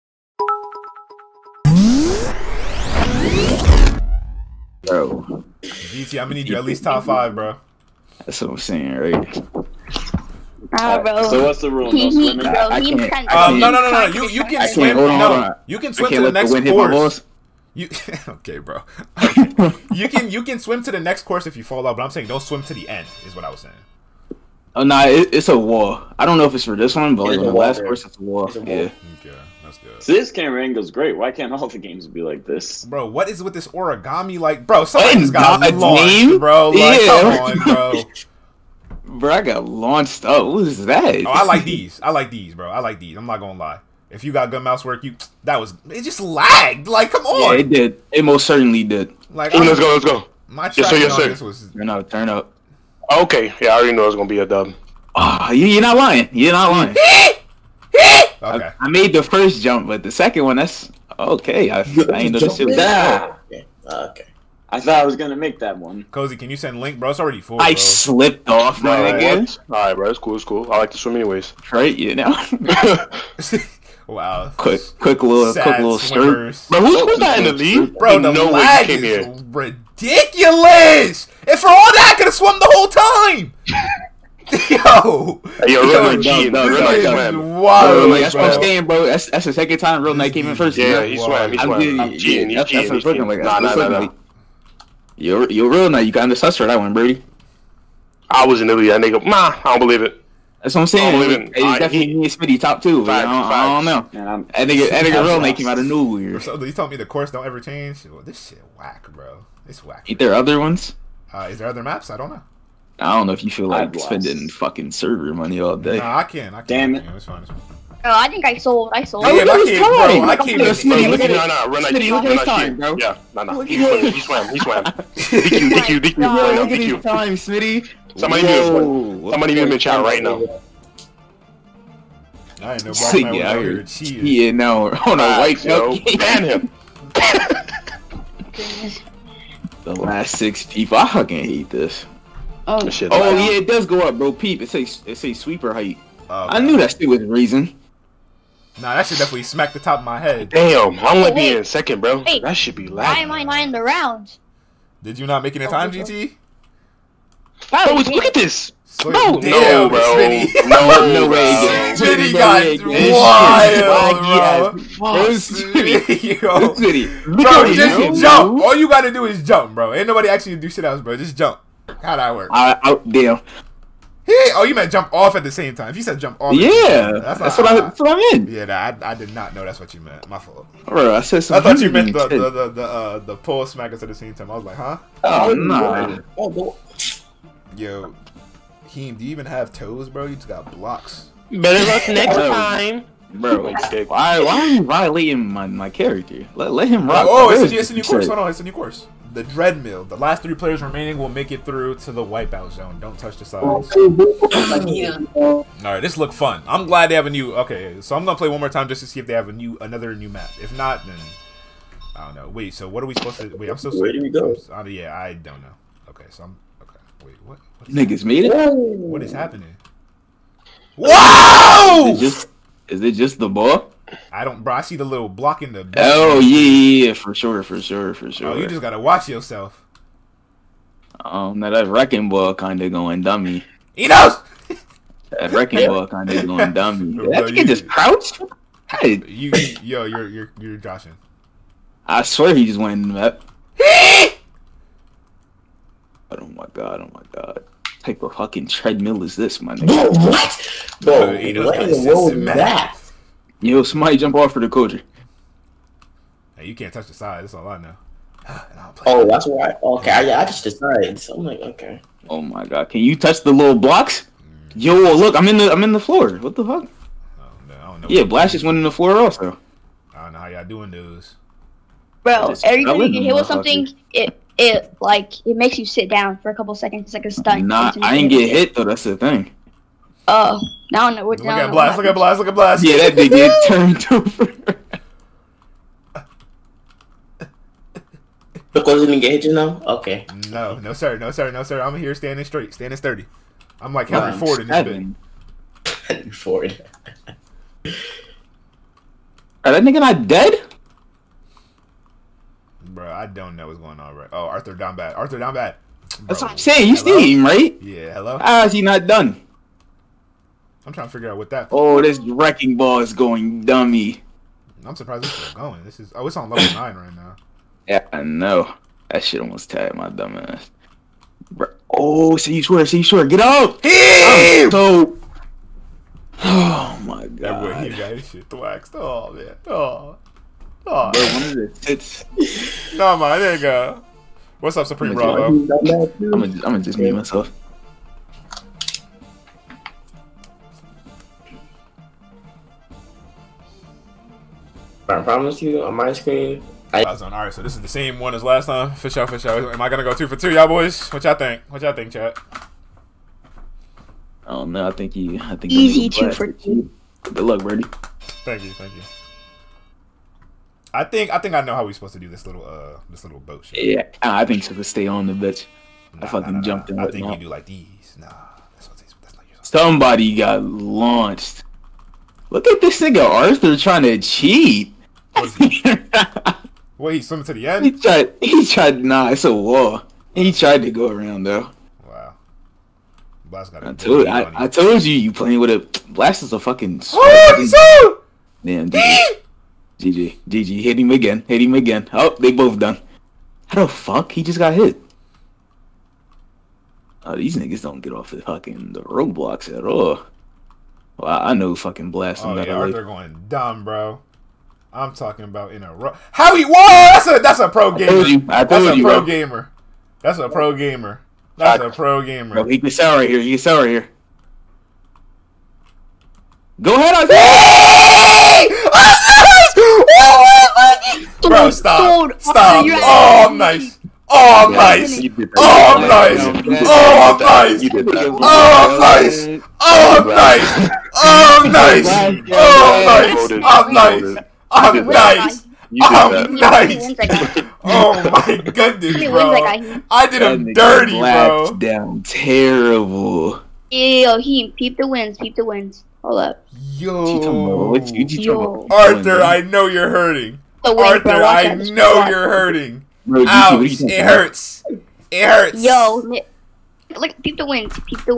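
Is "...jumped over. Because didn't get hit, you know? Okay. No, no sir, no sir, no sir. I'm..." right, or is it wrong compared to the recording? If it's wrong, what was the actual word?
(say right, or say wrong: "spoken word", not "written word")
wrong: "turned", not "jumped".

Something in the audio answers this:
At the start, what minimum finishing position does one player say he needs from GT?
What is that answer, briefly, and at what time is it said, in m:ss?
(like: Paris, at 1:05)
Top 5, at 0:06.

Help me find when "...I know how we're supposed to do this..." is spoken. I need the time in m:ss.
6:01.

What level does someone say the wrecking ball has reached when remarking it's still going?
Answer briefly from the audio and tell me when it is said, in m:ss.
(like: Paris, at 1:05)
9, at 5:16.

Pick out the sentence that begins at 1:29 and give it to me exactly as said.
That's that's the second time real night came in first.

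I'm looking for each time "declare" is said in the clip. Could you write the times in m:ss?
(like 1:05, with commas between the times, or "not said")
not said.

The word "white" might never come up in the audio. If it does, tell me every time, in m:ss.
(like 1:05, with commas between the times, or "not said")
2:15.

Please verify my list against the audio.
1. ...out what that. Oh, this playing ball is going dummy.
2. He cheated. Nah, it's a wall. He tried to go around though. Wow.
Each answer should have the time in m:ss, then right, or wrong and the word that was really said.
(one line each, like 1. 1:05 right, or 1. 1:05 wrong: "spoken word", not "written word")
1. 5:11 wrong: "wrecking", not "playing"
2. 6:18 wrong: "tried", not "cheated".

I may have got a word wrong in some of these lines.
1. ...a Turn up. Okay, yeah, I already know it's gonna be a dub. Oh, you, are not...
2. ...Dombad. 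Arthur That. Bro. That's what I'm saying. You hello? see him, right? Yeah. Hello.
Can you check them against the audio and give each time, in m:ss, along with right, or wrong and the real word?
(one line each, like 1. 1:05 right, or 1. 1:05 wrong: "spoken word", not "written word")
1. 0:51 right
2. 5:04 wrong: "Dombad", not "That".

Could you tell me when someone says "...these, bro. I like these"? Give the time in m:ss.
0:42.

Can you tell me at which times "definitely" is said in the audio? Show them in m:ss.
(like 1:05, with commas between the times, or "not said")
1:41, 2:29.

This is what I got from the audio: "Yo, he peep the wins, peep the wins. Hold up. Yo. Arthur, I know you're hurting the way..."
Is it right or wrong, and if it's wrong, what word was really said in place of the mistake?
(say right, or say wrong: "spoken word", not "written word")
right.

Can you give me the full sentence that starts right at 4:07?
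What type of fucking treadmill is this, my nigga?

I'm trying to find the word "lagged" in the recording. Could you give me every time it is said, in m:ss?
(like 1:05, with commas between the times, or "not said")
0:46.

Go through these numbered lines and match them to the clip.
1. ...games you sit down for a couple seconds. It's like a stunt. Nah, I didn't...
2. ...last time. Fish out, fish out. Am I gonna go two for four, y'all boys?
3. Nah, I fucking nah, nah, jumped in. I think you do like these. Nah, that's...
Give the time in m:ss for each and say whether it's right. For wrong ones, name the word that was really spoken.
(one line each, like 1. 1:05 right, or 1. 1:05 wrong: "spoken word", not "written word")
1. 4:35 wrong: "makes", not "games"
2. 5:48 wrong: "two", not "four"
3. 6:06 right.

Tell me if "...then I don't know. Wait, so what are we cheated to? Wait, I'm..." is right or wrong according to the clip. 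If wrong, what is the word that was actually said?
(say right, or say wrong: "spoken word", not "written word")
wrong: "supposed", not "cheated".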